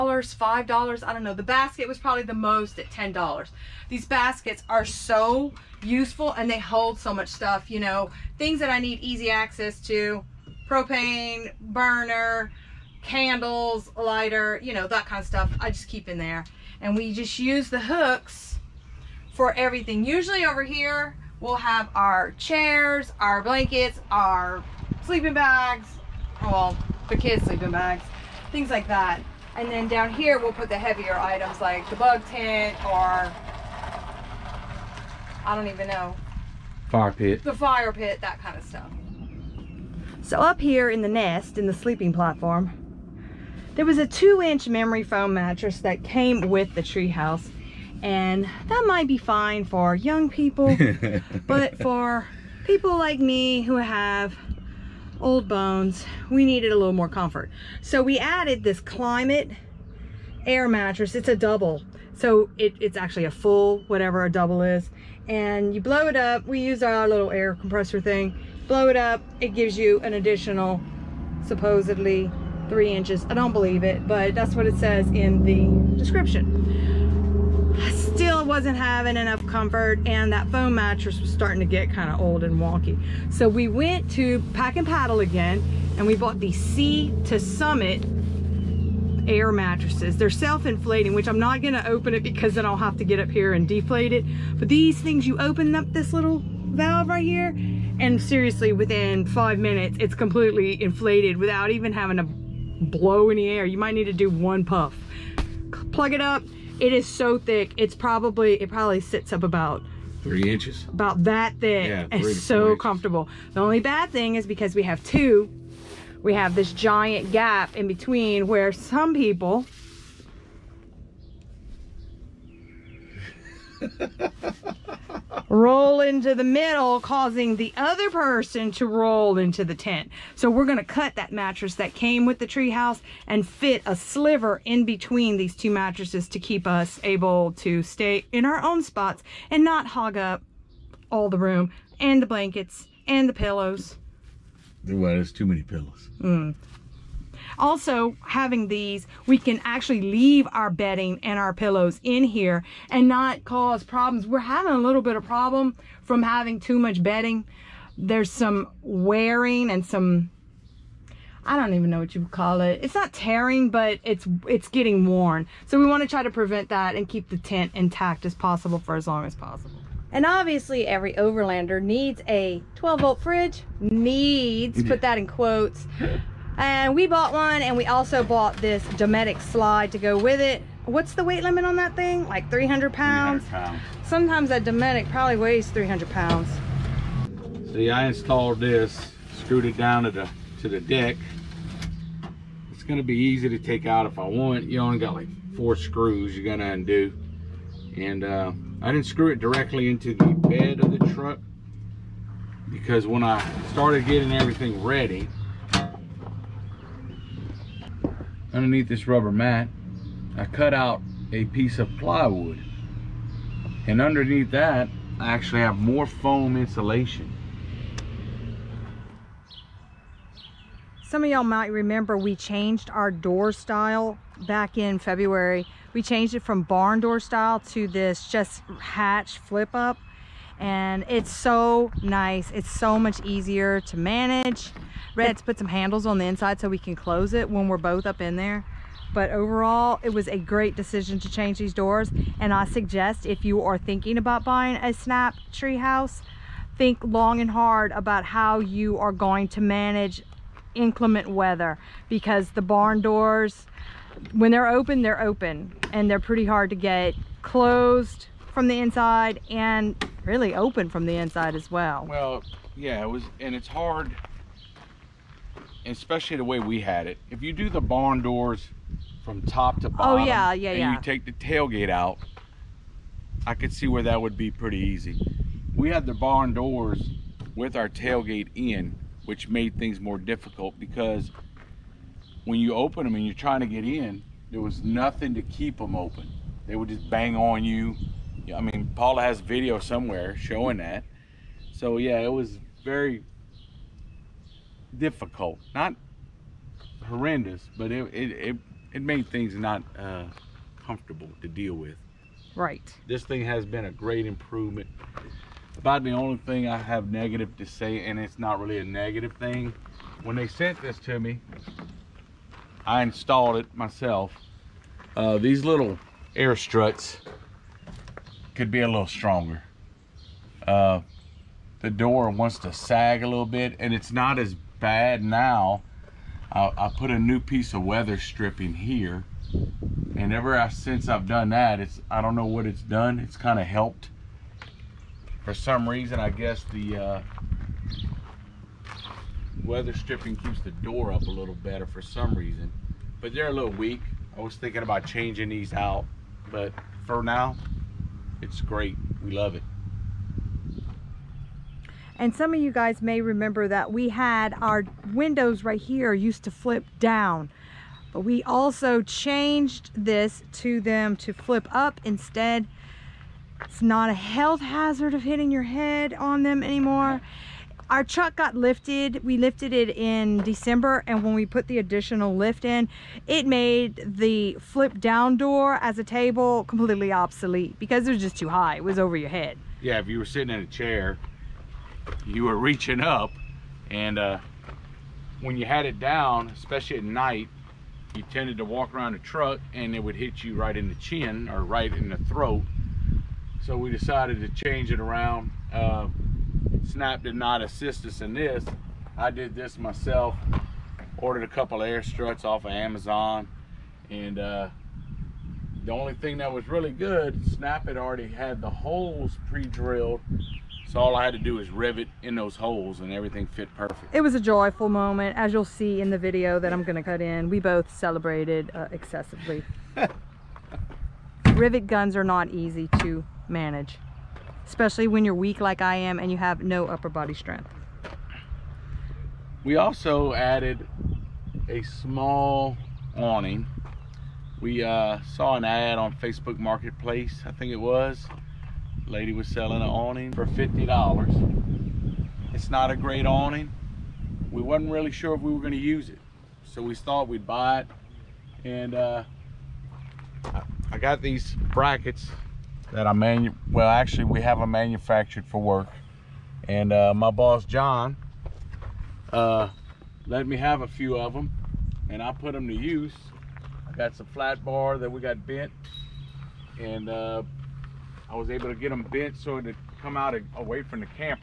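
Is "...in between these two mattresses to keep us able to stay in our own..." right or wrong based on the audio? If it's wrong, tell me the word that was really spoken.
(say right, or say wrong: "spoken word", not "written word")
right.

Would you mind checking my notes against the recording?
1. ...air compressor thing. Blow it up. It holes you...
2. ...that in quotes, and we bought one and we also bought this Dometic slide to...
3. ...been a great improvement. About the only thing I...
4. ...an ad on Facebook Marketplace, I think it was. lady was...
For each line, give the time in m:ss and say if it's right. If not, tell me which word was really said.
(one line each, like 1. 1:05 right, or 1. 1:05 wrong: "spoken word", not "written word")
1. 1:07 wrong: "gives", not "holes"
2. 2:55 right
3. 5:03 right
4. 7:15 right.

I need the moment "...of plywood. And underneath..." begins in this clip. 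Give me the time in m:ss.
3:31.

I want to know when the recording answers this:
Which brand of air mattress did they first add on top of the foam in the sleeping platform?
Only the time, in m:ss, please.
0:58.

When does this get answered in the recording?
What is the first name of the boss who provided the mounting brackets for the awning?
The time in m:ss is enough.
7:37.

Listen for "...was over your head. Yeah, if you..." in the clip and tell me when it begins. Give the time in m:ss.
6:18.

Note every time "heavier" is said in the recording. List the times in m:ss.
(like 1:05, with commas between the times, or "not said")
0:30.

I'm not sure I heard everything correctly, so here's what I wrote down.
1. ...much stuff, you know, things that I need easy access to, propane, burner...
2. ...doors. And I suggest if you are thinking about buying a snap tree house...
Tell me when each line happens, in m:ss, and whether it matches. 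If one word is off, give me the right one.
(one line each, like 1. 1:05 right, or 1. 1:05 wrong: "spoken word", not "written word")
1. 0:07 right
2. 4:01 right.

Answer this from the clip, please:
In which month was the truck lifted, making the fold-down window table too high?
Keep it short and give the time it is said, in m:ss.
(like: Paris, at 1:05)
December, at 6:10.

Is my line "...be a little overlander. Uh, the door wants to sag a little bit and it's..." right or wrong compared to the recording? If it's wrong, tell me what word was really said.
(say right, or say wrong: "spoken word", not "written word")
wrong: "stronger", not "overlander".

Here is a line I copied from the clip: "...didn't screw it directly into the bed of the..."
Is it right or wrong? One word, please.
right.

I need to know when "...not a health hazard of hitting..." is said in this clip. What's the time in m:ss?
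6:03.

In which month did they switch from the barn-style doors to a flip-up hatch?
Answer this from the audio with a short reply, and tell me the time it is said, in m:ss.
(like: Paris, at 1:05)
February, at 3:44.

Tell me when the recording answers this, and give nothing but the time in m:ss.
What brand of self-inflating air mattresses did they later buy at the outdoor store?
1:26.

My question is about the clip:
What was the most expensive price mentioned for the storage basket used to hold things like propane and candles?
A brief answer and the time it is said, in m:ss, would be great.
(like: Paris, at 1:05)
$10, at 0:02.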